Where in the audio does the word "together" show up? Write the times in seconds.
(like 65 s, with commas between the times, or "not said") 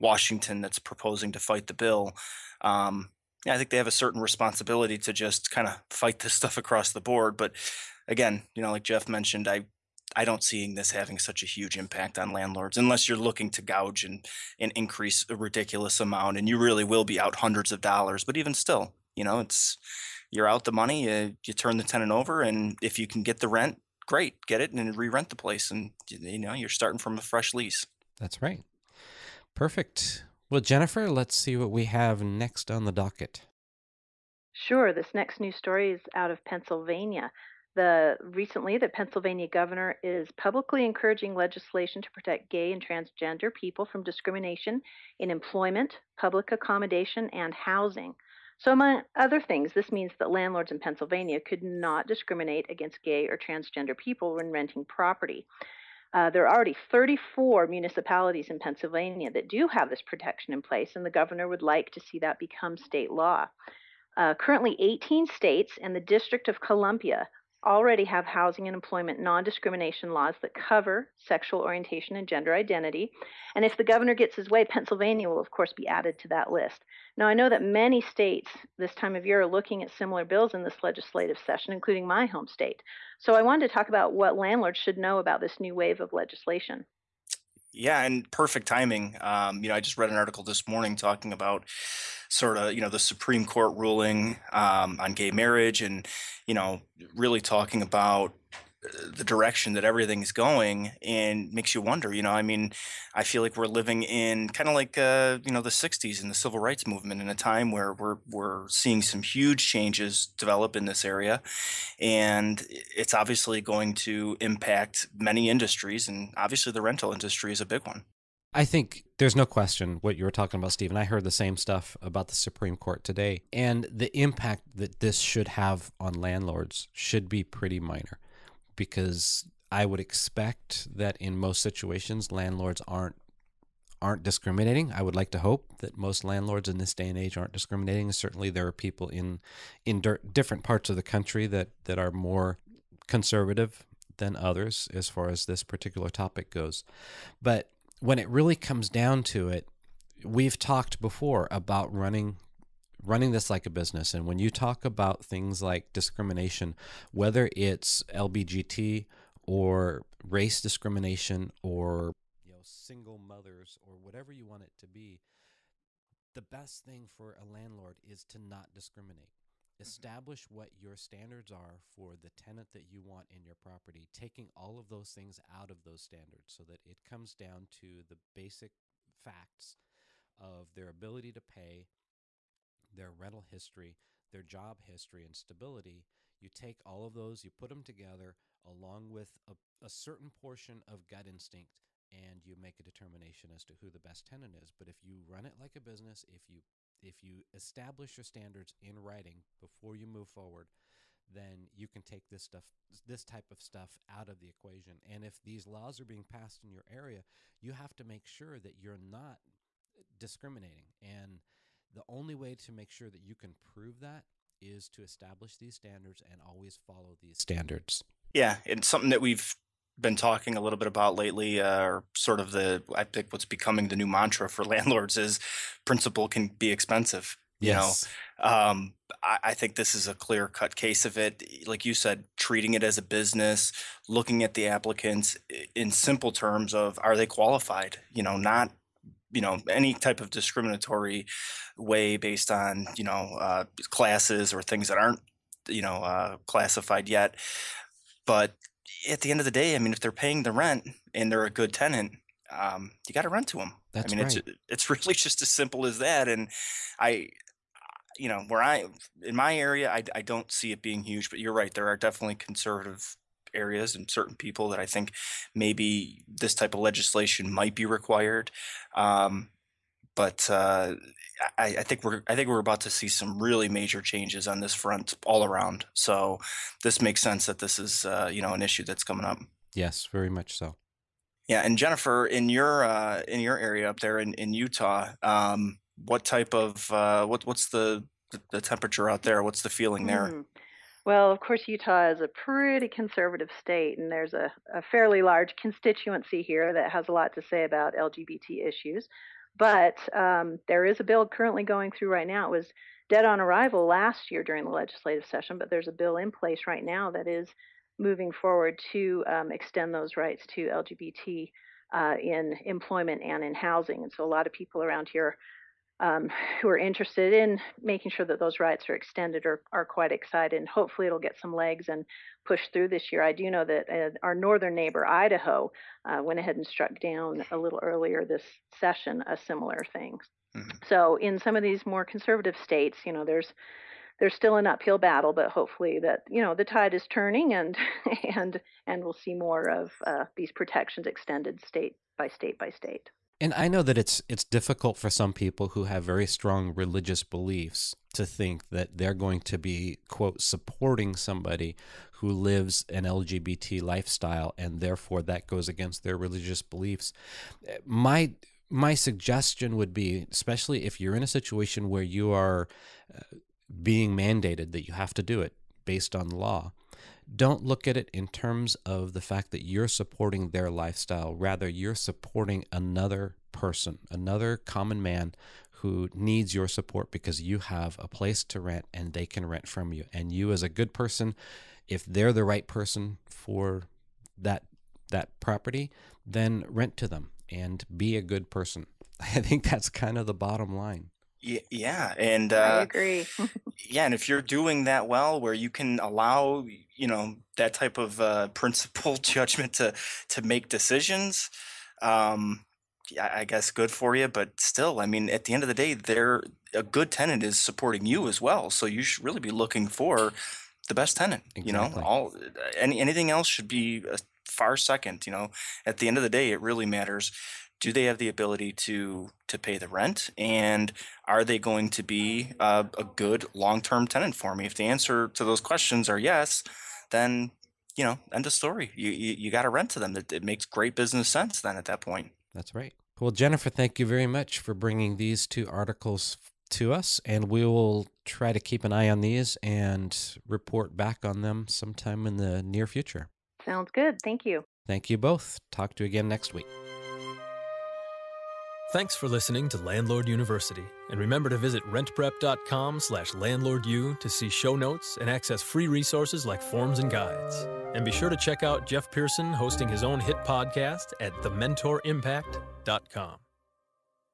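187 s.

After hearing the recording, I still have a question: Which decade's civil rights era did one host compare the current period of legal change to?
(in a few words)
the 60s.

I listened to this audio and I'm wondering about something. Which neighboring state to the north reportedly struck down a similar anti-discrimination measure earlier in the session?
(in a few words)
Idaho.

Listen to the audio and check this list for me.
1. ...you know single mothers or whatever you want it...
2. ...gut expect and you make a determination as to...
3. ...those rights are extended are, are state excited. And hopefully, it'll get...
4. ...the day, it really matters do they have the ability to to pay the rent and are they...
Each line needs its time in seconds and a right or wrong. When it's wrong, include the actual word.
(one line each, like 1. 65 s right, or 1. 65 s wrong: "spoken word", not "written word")
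1. 162 s right
2. 191 s wrong: "instinct", not "expect"
3. 318 s wrong: "quite", not "state"
4. 416 s right.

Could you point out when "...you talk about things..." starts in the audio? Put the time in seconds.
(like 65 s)
154 s.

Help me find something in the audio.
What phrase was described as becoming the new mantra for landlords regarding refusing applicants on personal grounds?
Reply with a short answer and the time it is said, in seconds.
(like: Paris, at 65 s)
principle can be expensive, at 225 s.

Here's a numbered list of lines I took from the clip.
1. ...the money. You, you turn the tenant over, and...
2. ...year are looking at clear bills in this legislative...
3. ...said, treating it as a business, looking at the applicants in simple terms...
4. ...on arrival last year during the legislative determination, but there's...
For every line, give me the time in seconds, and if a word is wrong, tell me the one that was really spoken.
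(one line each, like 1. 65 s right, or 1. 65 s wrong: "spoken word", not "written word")
1. 20 s right
2. 79 s wrong: "similar", not "clear"
3. 231 s right
4. 303 s wrong: "session", not "determination".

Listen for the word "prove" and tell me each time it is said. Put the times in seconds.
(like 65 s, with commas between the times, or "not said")
213 s.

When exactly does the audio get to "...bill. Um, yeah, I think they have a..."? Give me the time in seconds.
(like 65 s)
1 s.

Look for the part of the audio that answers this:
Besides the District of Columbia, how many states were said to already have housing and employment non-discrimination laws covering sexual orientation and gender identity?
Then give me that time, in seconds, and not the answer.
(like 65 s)
64 s.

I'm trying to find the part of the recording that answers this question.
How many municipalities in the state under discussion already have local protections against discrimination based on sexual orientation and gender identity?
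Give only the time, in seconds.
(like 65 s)
56 s.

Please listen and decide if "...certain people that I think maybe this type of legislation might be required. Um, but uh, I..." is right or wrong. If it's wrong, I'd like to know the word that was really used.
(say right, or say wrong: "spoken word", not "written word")
right.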